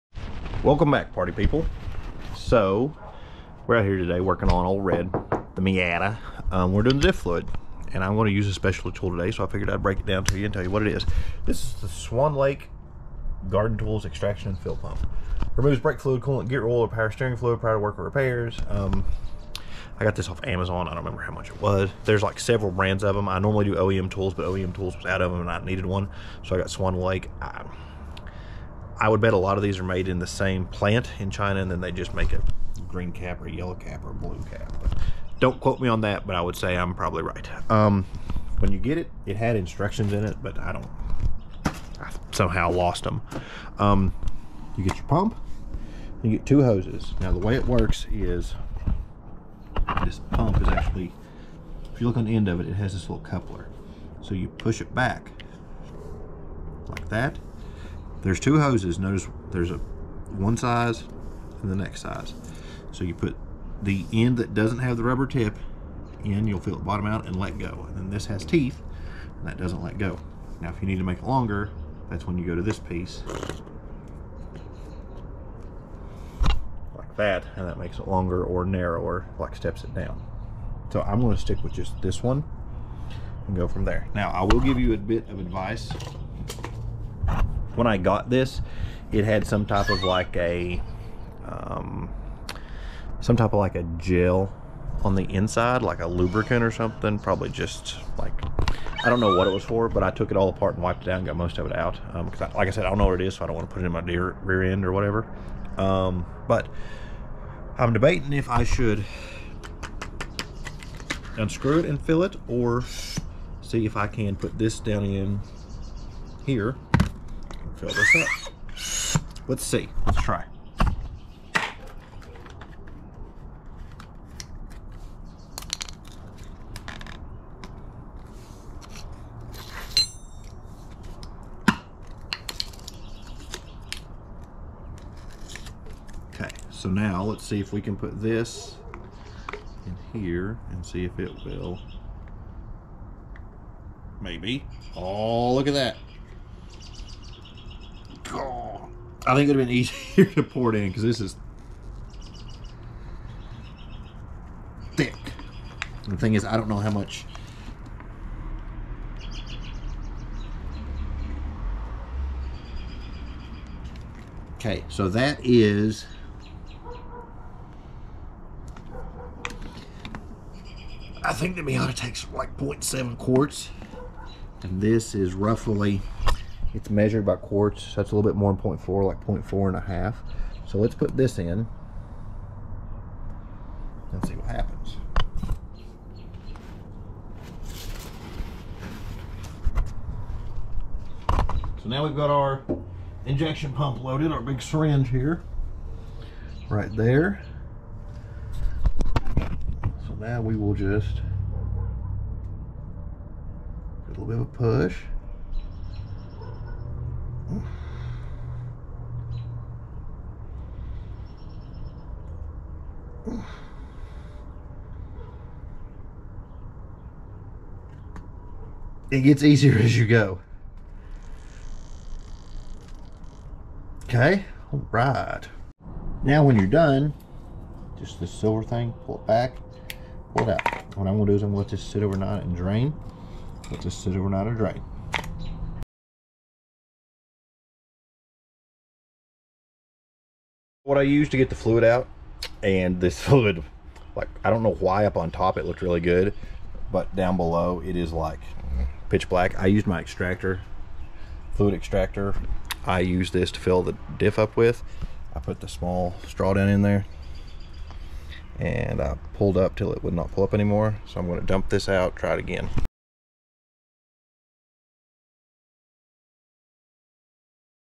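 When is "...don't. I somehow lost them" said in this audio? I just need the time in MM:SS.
00:40.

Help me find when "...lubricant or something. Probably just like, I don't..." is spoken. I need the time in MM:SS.
01:36.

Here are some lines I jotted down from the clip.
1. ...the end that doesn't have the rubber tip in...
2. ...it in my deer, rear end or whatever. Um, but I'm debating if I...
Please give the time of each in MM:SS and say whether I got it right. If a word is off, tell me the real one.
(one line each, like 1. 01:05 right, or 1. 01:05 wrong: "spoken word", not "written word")
1. 01:03 right
2. 01:43 right.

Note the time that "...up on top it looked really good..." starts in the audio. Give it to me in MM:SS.
04:05.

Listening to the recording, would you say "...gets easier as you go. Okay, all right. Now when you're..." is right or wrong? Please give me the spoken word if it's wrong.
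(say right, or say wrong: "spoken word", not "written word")
right.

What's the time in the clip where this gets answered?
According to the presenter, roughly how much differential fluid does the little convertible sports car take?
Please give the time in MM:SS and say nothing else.
02:52.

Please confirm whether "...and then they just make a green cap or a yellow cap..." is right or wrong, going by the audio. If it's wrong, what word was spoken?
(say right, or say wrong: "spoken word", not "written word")
right.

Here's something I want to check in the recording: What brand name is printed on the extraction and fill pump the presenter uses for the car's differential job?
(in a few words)
Swan Lake Garden Tools.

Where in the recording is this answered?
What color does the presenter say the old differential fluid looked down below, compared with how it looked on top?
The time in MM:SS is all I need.
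04:09.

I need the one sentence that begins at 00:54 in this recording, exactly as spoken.
So you push it back like that there's two hoses.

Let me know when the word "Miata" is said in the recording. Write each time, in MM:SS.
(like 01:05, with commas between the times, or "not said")
00:05, 02:51.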